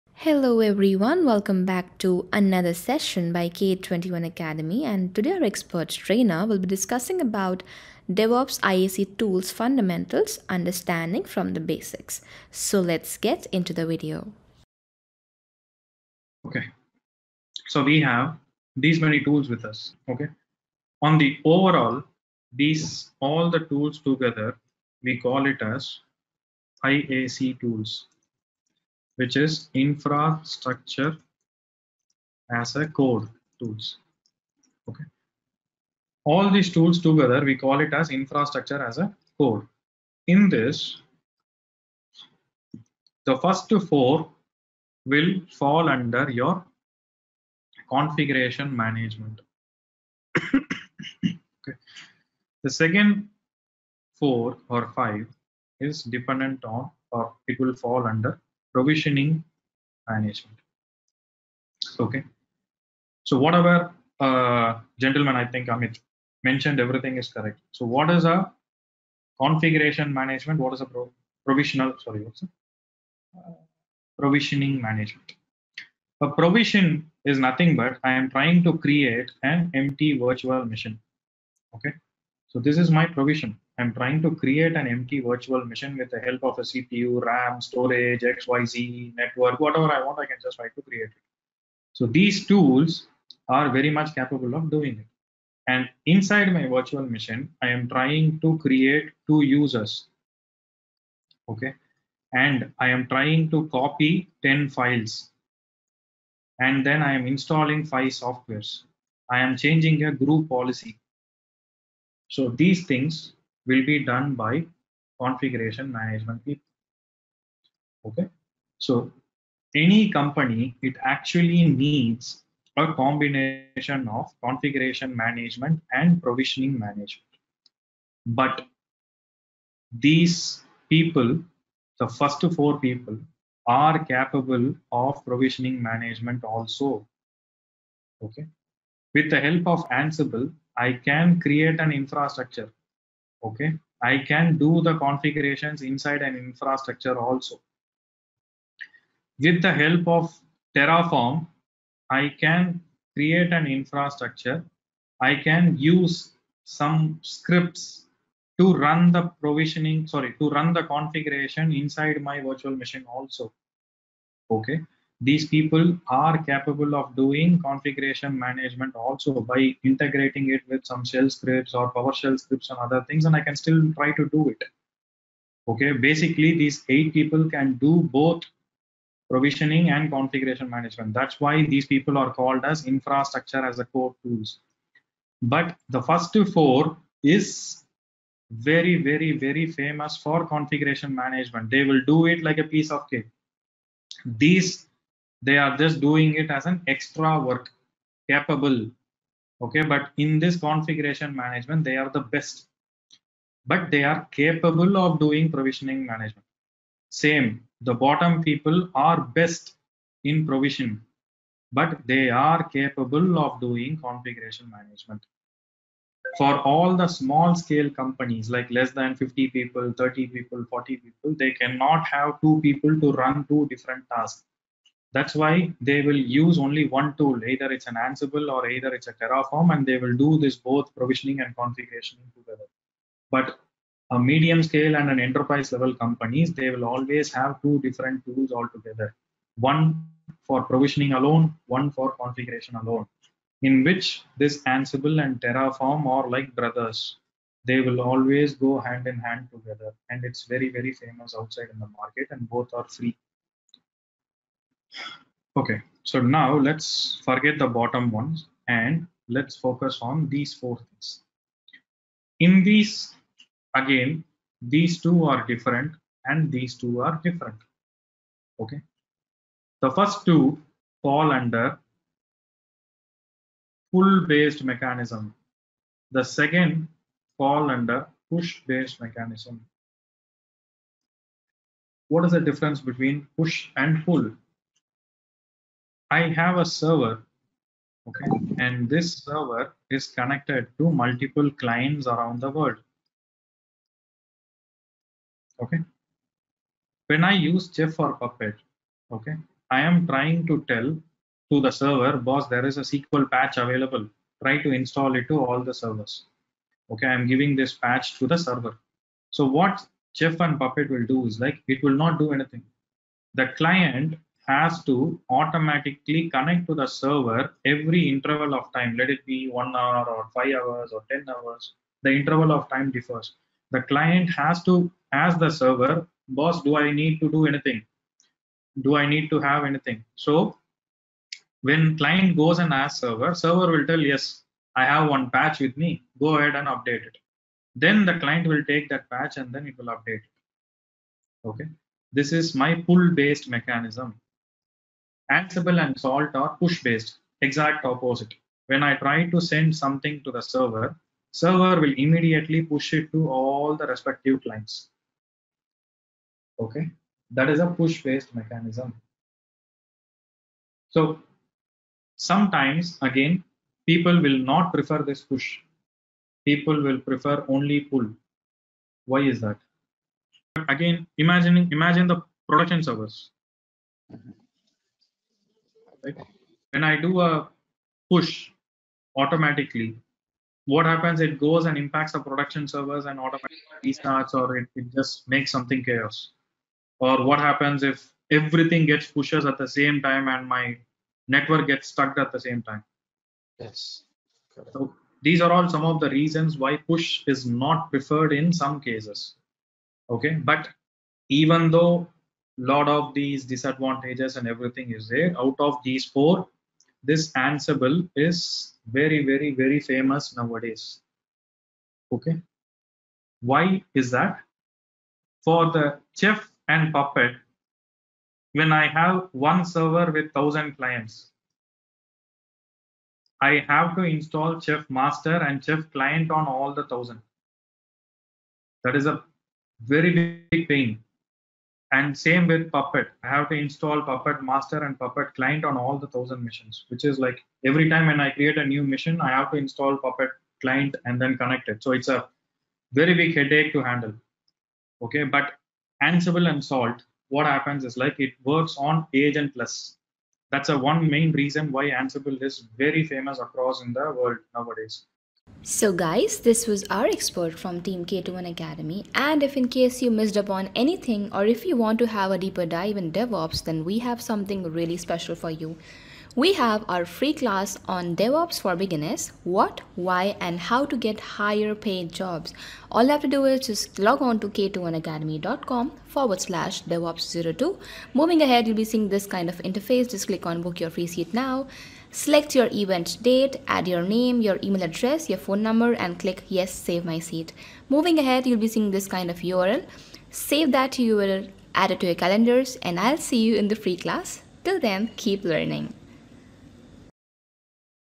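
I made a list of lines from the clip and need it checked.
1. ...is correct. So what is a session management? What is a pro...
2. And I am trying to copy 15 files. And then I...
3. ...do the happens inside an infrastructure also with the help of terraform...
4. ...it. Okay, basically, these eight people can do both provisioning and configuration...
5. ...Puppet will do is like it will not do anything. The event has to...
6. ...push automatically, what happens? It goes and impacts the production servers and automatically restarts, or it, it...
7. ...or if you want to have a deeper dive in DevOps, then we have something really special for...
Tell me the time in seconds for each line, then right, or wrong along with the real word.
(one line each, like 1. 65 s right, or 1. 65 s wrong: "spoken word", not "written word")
1. 67 s wrong: "configuration", not "session"
2. 102 s wrong: "10", not "15"
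3. 144 s wrong: "configurations", not "happens"
4. 174 s right
5. 310 s wrong: "client", not "event"
6. 378 s right
7. 461 s right.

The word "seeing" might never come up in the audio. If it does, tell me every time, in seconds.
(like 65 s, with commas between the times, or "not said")
478 s, 488 s.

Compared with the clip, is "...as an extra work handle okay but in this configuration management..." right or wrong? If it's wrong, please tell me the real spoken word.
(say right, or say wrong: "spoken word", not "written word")
wrong: "capable", not "handle".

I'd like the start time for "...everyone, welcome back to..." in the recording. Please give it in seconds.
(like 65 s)
0 s.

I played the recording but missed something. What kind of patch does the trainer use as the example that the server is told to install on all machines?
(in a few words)
SQL patch.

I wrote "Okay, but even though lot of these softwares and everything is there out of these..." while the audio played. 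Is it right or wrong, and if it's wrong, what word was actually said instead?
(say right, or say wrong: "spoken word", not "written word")
wrong: "disadvantages", not "softwares".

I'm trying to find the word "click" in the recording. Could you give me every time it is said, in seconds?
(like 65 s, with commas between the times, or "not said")
480 s, 486 s.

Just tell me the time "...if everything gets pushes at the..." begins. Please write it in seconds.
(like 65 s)
387 s.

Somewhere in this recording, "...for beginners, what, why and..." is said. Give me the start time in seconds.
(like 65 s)
468 s.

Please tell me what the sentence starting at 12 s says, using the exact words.
So let's get into the video.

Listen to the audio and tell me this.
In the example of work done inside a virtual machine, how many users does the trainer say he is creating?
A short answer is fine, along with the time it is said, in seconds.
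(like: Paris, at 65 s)
2, at 99 s.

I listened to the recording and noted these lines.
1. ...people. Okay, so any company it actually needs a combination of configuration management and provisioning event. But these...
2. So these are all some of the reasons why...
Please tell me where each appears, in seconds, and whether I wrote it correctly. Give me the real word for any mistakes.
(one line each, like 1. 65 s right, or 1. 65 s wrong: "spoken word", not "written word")
1. 116 s wrong: "management", not "event"
2. 394 s right.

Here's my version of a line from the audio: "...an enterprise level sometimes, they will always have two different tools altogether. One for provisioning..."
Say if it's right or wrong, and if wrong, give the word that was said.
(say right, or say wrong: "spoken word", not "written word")
wrong: "companies", not "sometimes".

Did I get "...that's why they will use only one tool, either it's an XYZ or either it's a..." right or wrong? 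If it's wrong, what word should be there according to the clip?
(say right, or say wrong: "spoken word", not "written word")
wrong: "Ansible", not "XYZ".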